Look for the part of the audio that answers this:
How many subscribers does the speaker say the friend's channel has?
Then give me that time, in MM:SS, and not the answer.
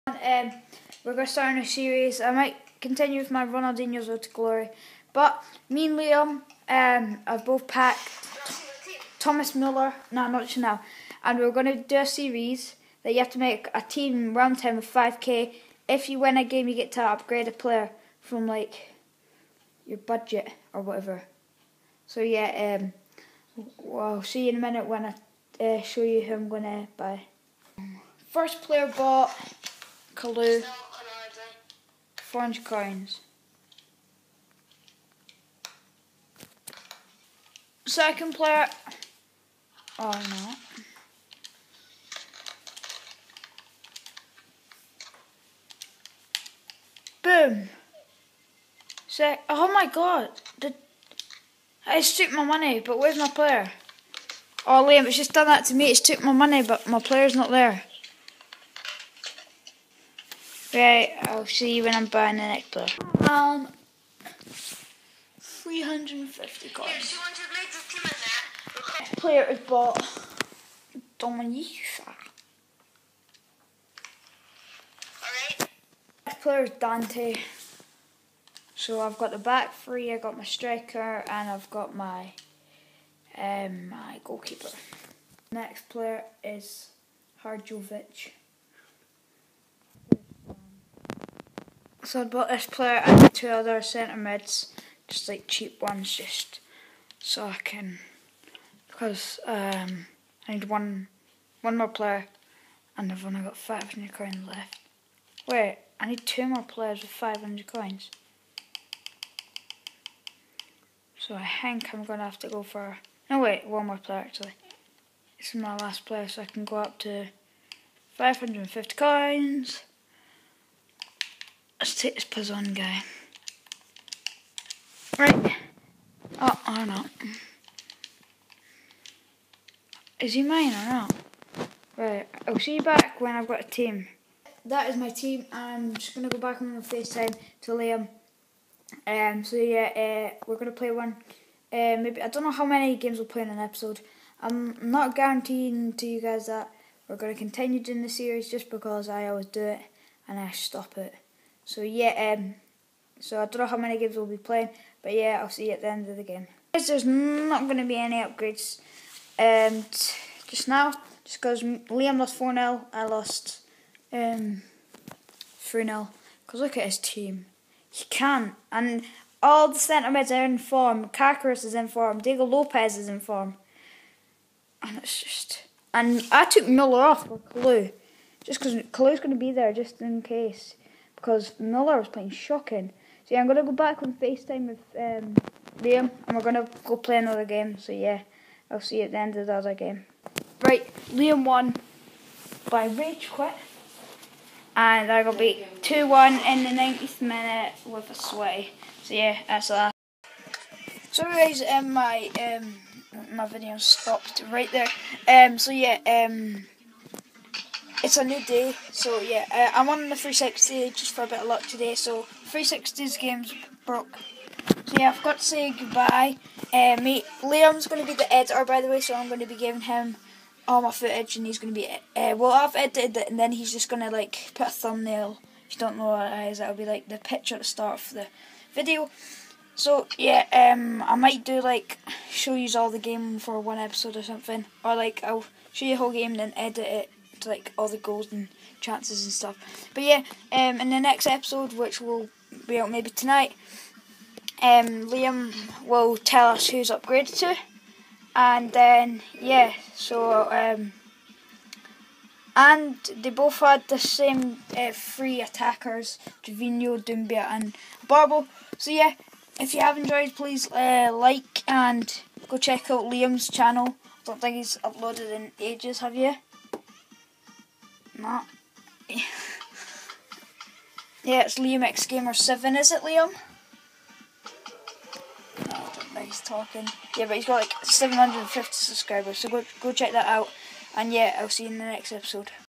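04:37.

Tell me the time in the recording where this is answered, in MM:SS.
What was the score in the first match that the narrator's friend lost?
02:42.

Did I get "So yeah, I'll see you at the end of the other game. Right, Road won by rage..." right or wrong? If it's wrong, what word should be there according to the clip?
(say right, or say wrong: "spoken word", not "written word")
wrong: "Liam", not "Road".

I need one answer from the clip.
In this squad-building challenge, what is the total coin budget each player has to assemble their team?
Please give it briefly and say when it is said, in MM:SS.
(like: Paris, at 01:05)
5k, at 00:14.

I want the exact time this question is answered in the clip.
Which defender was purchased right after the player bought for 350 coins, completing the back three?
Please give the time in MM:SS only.
01:16.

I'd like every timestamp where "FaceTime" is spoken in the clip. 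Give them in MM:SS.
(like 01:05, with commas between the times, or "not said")
02:16, 03:04.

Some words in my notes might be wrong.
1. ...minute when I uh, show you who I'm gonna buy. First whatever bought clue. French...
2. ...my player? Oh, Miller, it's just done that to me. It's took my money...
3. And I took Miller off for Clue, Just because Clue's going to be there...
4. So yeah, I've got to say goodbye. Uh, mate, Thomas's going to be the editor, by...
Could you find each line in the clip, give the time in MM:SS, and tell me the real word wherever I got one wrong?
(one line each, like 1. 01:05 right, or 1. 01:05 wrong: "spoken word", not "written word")
1. 00:24 wrong: "player", not "whatever"
2. 00:53 wrong: "Liam", not "Miller"
3. 02:55 right
4. 03:34 wrong: "Liam", not "Thomas".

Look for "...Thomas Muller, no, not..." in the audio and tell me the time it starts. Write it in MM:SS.
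00:09.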